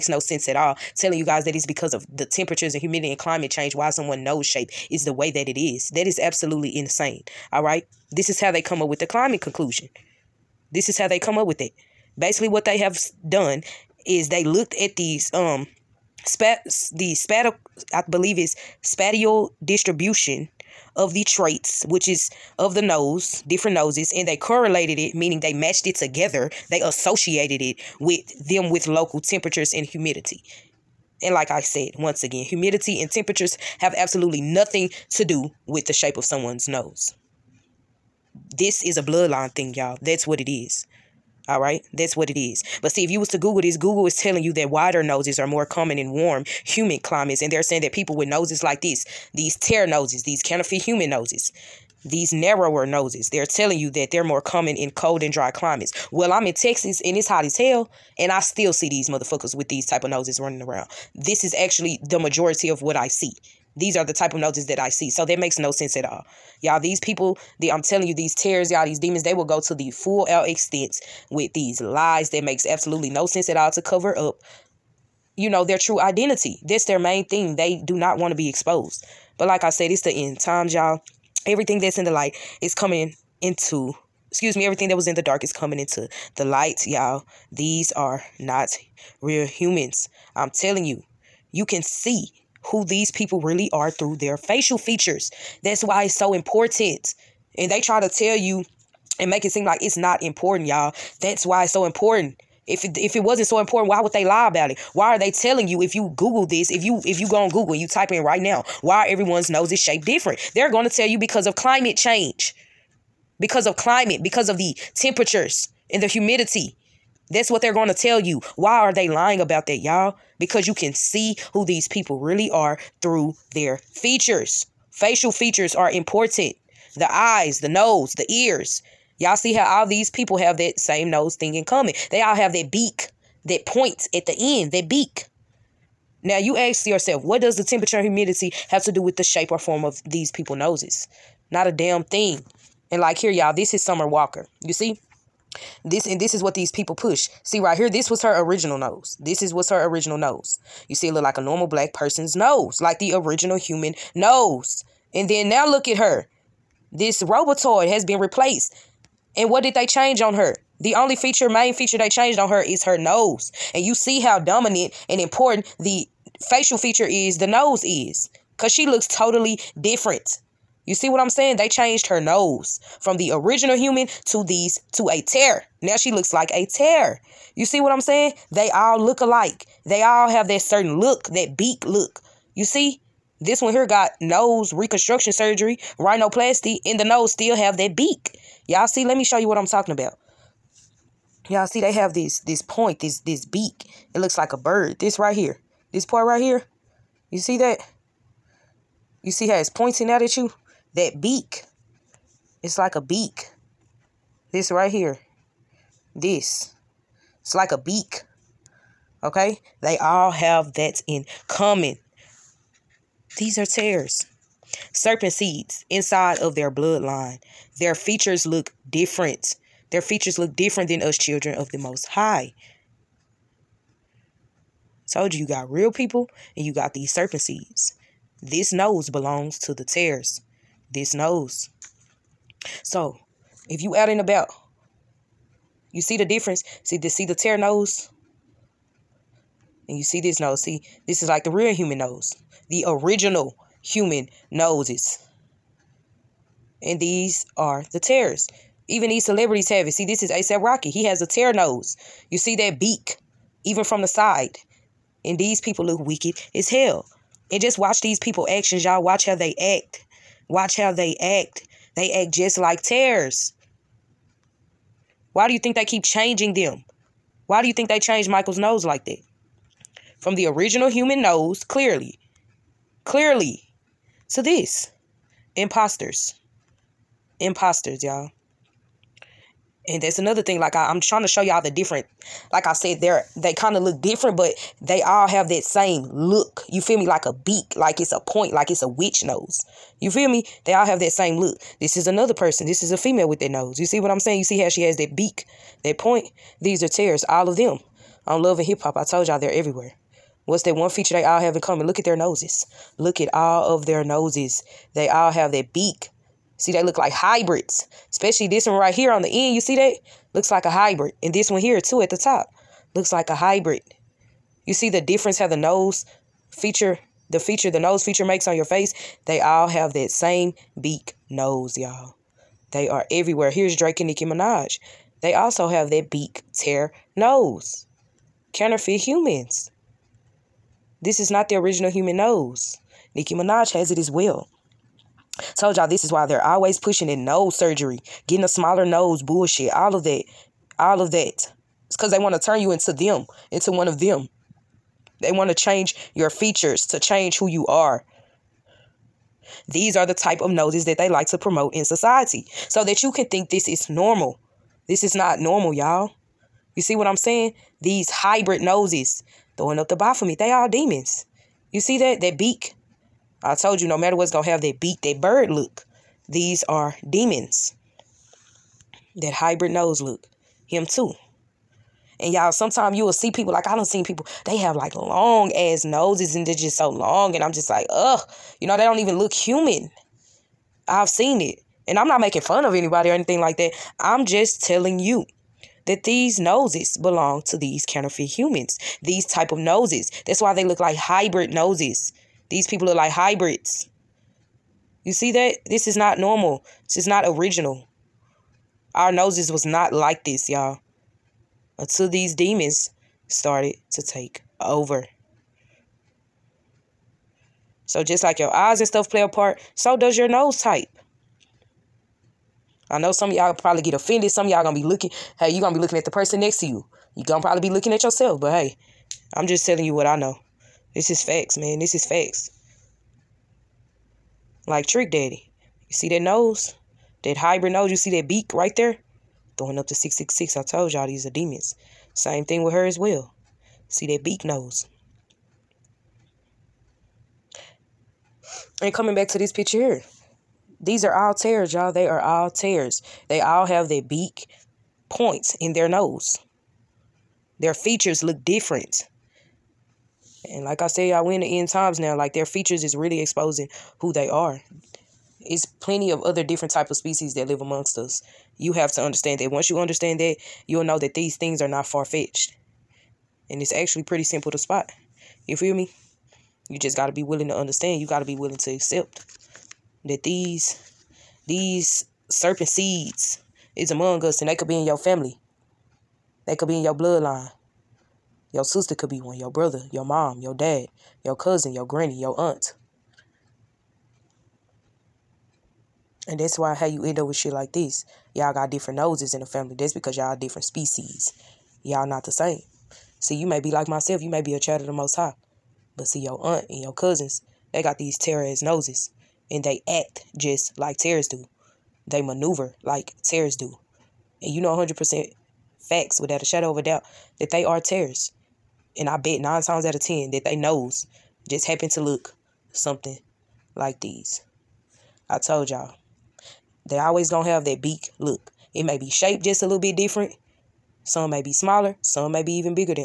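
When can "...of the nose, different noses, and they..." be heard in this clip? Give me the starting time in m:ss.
0:22.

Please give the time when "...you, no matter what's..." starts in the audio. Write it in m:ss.
6:03.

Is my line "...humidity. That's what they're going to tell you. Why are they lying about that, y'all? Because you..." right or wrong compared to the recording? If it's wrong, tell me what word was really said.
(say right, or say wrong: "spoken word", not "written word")
right.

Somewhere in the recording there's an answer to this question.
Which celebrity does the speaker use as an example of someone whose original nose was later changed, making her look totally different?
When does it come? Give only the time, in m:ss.
2:23.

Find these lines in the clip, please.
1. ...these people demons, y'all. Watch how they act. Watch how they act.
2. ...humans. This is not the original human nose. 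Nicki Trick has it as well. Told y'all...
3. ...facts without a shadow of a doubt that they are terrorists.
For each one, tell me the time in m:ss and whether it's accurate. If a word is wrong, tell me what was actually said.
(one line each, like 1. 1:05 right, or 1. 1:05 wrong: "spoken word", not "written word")
1. 4:18 wrong: "actions", not "demons"
2. 5:28 wrong: "Minaj", not "Trick"
3. 8:25 right.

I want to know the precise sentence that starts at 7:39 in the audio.
Once you understand that, you'll know that these things are not far fetched.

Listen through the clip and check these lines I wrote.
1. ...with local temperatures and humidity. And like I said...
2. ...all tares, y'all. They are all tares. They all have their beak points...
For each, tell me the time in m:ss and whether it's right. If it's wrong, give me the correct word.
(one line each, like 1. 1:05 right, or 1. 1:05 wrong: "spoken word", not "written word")
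1. 0:28 right
2. 7:21 right.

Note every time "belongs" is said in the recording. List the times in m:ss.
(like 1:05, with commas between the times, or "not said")
3:49, 6:26.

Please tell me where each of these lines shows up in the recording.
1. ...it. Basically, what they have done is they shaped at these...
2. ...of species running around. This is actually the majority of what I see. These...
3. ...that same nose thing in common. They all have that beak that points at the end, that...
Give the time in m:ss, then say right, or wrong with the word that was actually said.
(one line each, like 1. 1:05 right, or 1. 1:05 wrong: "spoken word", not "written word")
1. 0:11 wrong: "looked", not "shaped"
2. 1:00 wrong: "noses", not "species"
3. 2:10 right.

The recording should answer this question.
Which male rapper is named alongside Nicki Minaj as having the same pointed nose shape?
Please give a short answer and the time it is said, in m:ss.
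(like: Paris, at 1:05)
Drake, at 5:23.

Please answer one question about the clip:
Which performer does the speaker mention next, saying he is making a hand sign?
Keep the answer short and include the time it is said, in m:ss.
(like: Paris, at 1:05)
Trick Daddy, at 7:04.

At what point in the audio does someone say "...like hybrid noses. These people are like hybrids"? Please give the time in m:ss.
6:30.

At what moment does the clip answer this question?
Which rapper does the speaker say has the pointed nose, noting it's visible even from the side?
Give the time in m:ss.
4:10.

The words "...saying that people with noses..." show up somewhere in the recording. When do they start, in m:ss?
0:47.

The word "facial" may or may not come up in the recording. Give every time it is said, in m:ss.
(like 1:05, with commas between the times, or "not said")
1:34, 2:04, 2:46.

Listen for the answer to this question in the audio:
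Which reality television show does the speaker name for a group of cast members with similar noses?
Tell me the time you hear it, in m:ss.
4:58.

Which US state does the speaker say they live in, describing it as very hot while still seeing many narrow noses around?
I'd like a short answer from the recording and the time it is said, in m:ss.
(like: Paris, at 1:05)
Texas, at 0:56.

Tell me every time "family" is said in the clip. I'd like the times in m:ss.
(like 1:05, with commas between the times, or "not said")
7:54, 8:09.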